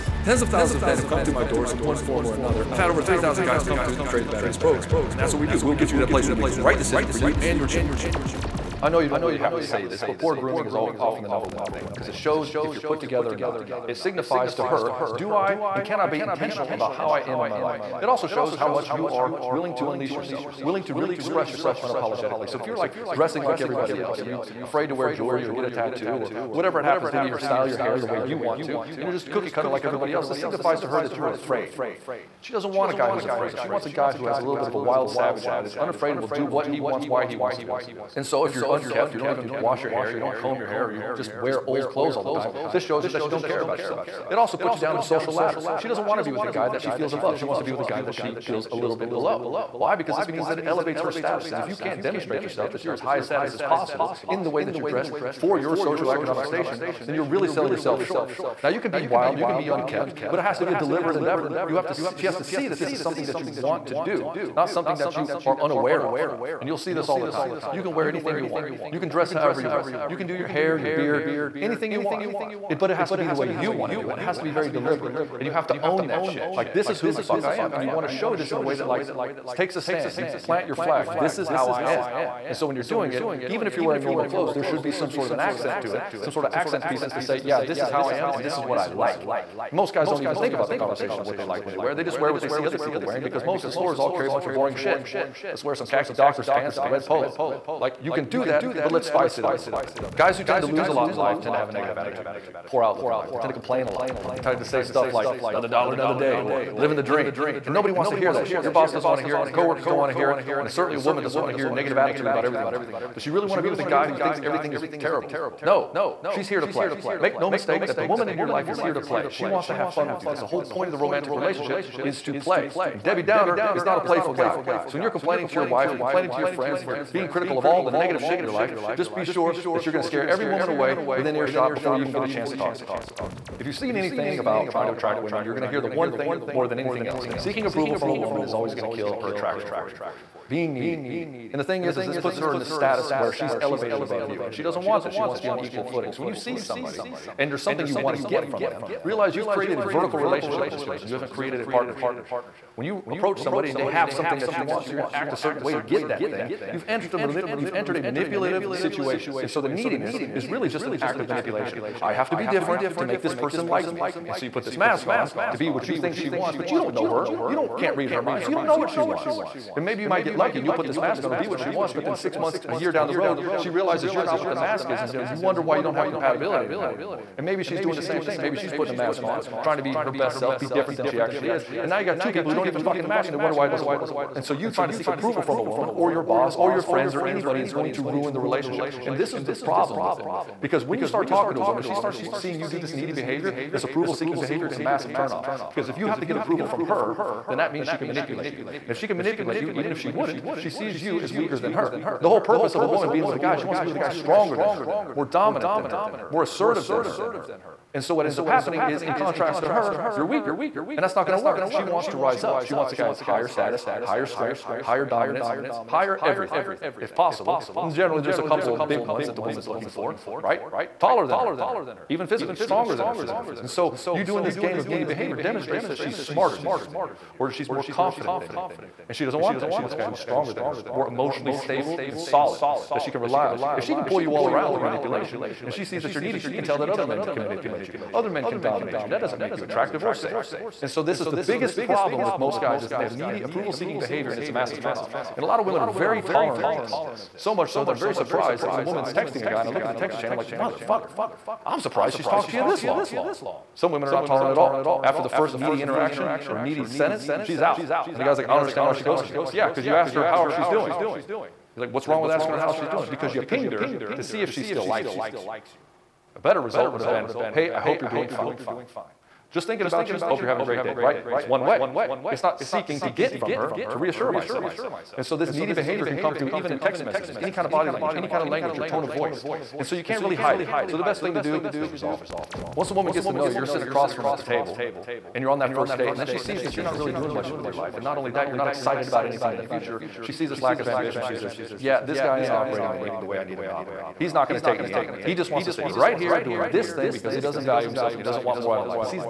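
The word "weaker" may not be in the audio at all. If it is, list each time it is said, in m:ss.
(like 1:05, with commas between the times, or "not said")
3:21, 3:30.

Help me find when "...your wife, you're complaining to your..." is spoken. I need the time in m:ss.
2:05.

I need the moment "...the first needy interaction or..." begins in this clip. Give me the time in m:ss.
4:15.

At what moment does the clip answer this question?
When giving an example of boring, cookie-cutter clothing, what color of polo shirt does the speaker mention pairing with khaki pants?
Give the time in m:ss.
1:36.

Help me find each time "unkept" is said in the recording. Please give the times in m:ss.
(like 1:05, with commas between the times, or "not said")
0:38, 0:59.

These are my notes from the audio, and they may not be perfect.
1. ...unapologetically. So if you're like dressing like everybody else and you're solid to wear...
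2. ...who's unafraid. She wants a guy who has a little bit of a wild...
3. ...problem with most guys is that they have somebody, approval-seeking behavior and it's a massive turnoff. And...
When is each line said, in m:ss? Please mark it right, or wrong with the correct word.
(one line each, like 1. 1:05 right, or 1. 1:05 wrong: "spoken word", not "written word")
1. 0:21 wrong: "afraid", not "solid"
2. 0:33 wrong: "afraid", not "unafraid"
3. 4:01 wrong: "needy", not "somebody".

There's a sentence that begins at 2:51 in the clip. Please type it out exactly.
But then six months, a year down the road, she realizes you're not what the mask is.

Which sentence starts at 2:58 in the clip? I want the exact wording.
Maybe she's putting a mask on, trying to be her best self, be different than she actually is.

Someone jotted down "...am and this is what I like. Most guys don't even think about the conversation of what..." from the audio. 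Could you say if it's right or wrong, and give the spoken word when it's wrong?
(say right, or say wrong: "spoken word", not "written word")
right.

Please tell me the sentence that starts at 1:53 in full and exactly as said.
Does she really want to be with a guy who thinks everything is terrible?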